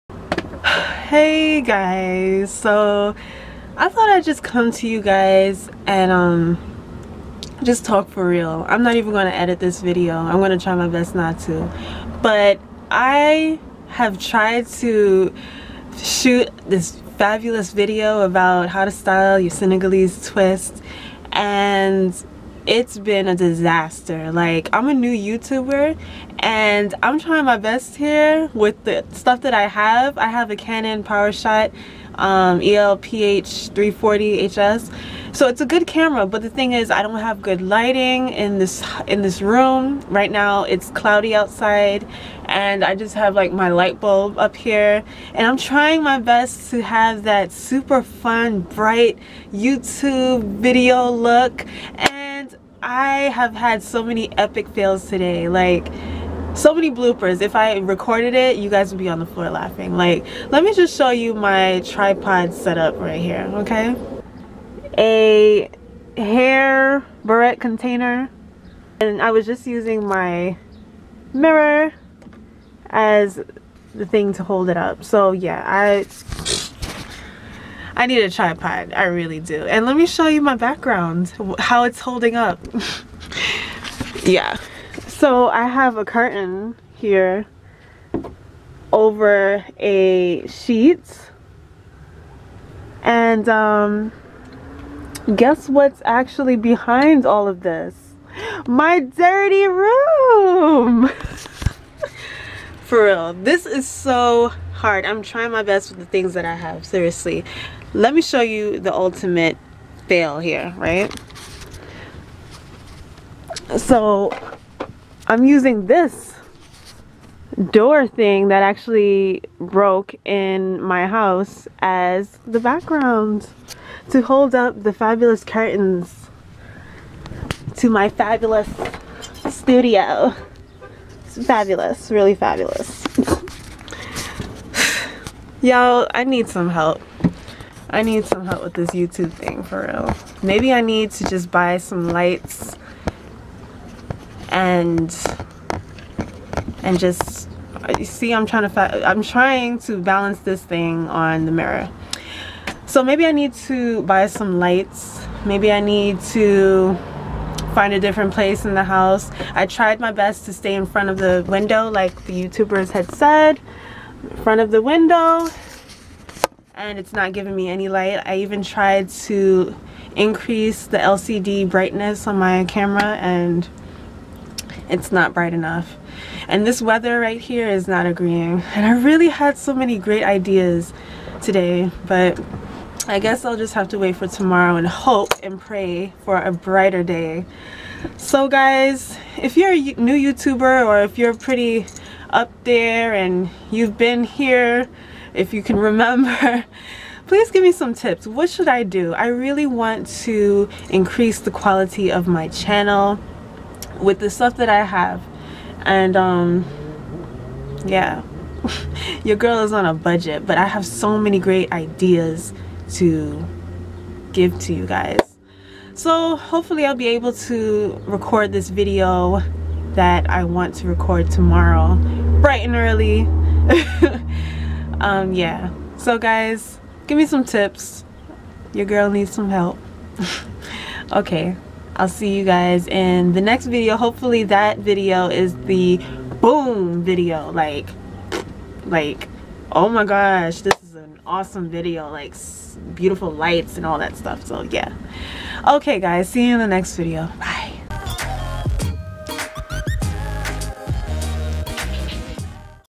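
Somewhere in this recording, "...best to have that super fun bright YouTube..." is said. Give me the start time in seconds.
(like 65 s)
46 s.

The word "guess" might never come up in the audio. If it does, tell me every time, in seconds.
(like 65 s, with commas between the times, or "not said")
95 s, 183 s.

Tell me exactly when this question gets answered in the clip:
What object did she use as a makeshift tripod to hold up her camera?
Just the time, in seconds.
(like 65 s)
64 s.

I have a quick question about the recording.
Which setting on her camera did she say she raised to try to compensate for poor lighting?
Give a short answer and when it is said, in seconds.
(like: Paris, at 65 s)
LCD brightness, at 170 s.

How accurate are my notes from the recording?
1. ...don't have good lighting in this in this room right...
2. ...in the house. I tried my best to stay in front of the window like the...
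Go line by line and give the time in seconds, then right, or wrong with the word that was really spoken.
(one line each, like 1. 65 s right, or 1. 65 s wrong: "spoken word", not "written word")
1. 37 s right
2. 158 s right.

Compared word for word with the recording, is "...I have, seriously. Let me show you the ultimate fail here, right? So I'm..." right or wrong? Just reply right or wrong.
right.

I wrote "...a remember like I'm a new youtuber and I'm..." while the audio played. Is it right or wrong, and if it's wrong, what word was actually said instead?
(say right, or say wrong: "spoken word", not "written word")
wrong: "disaster", not "remember".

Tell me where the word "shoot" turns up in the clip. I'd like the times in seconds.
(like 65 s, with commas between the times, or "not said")
15 s.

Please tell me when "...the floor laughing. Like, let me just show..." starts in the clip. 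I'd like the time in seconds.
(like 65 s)
59 s.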